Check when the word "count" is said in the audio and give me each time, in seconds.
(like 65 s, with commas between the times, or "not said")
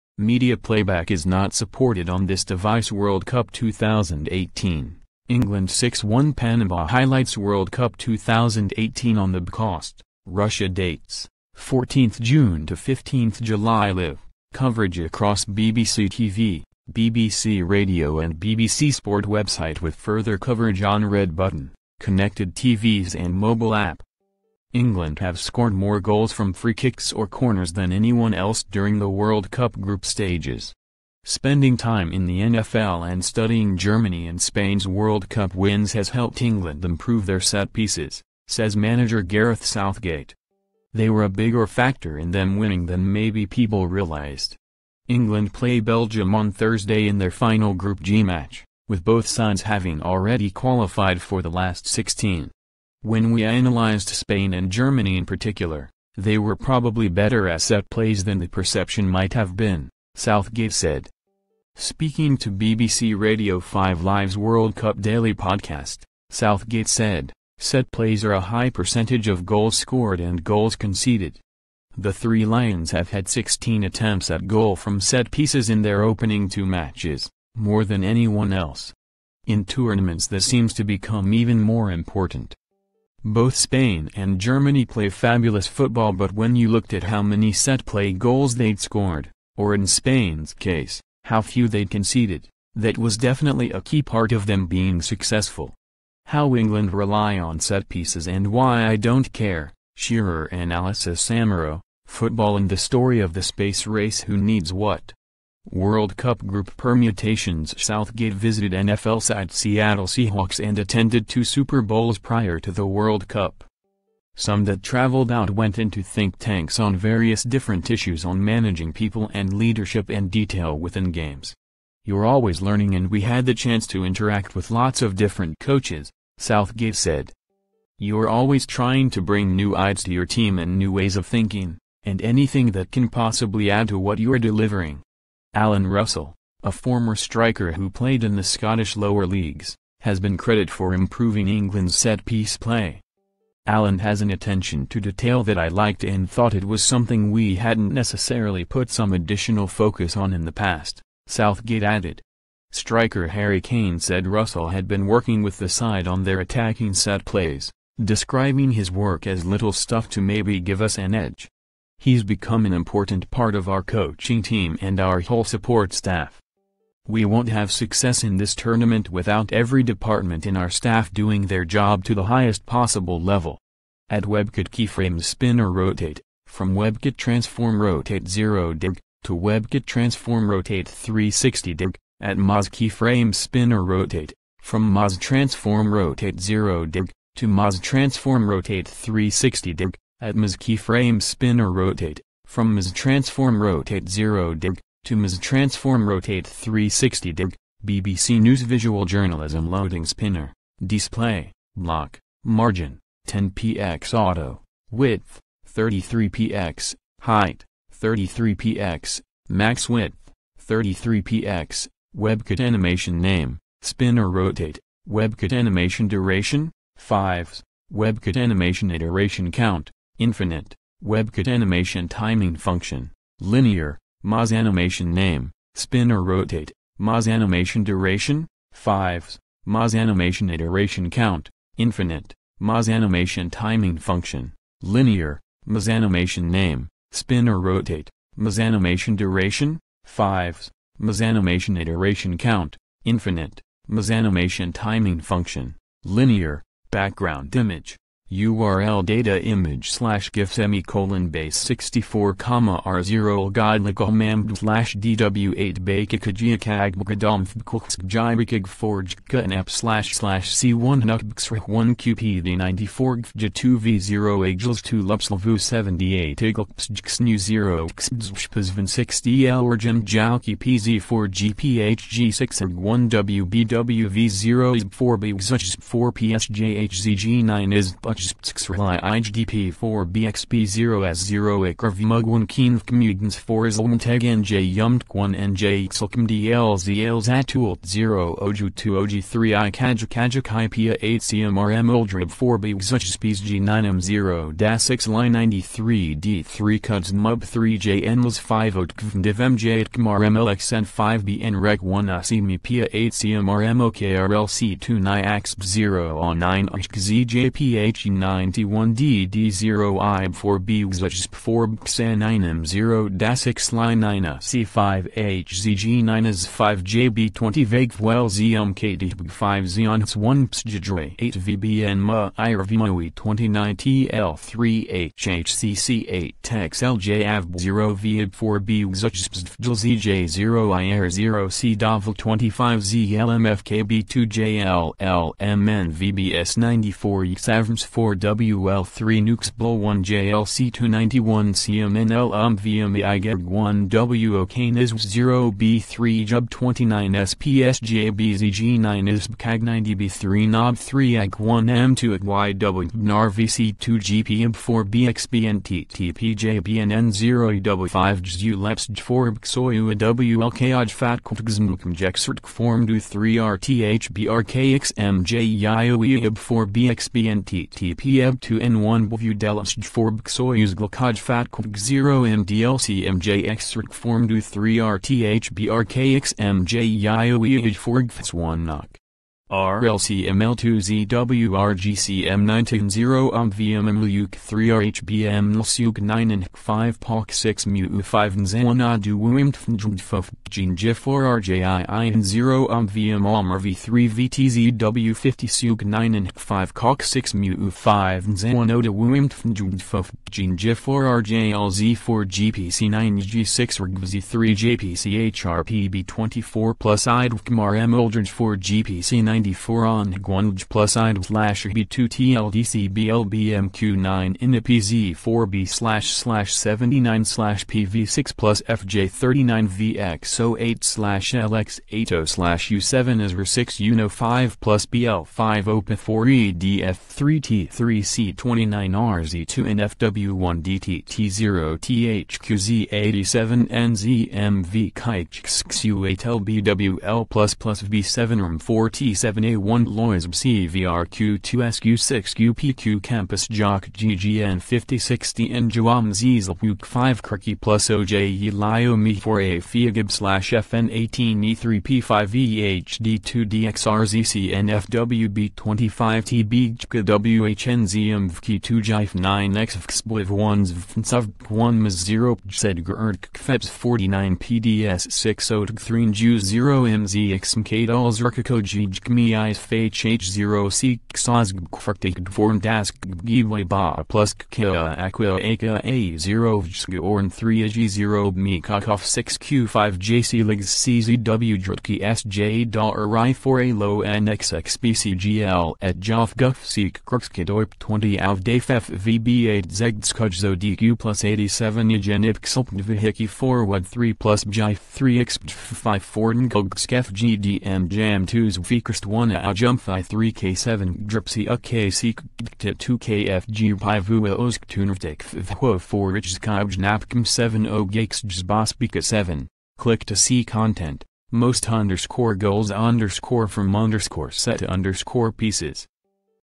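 219 s, 231 s, 242 s.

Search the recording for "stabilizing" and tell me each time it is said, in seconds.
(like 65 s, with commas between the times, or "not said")
not said.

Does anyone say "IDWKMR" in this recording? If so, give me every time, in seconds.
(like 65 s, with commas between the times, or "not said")
407 s.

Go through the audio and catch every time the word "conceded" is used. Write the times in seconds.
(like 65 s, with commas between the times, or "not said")
70 s, 91 s.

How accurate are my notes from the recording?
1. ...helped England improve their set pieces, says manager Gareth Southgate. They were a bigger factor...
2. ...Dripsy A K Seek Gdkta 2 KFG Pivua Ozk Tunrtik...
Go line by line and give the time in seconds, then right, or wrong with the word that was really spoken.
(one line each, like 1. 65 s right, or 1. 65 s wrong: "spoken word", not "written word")
1. 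36 s right
2. 501 s right.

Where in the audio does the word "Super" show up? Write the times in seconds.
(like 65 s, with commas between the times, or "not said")
111 s.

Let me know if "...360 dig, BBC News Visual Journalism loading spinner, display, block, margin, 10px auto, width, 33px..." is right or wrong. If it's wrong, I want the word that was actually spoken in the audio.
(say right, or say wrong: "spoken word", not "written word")
right.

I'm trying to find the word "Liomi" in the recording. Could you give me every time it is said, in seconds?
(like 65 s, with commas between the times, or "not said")
448 s.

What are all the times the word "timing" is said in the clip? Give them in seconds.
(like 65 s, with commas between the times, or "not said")
222 s, 233 s, 244 s.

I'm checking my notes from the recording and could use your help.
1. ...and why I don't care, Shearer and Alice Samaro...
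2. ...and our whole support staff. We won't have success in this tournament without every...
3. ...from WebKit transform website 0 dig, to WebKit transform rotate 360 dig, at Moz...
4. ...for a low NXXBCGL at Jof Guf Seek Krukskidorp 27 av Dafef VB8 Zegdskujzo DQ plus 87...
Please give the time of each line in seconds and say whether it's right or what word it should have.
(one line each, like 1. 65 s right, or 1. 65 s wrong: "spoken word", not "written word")
1. 98 s right
2. 164 s right
3. 176 s wrong: "rotate", not "website"
4. 483 s wrong: "20", not "27".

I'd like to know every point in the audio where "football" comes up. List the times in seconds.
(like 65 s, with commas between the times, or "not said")
85 s, 102 s.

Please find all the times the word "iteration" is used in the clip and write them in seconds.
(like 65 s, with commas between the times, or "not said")
218 s, 230 s, 241 s.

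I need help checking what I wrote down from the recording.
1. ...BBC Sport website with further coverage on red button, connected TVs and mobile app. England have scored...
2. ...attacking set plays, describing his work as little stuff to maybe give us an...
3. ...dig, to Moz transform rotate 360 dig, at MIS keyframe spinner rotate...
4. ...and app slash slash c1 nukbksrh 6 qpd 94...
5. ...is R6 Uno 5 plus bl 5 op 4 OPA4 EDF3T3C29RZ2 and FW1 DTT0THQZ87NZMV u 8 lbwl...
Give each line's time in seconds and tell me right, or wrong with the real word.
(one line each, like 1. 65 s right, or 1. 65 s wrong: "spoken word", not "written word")
1. 18 s right
2. 156 s right
3. 186 s right
4. 259 s wrong: "1", not "6"
5. 423 s right.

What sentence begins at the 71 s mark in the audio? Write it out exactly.
The three Lions have had 16 attempts at goal from set pieces in their opening two matches, more than anyone else.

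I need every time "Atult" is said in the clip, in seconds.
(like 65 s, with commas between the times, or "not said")
287 s.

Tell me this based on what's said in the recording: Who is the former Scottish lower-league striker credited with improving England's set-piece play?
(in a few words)
Alan Russell.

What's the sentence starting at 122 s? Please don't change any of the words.
You're always learning and we had the chance to interact with lots of different coaches, Southgate said.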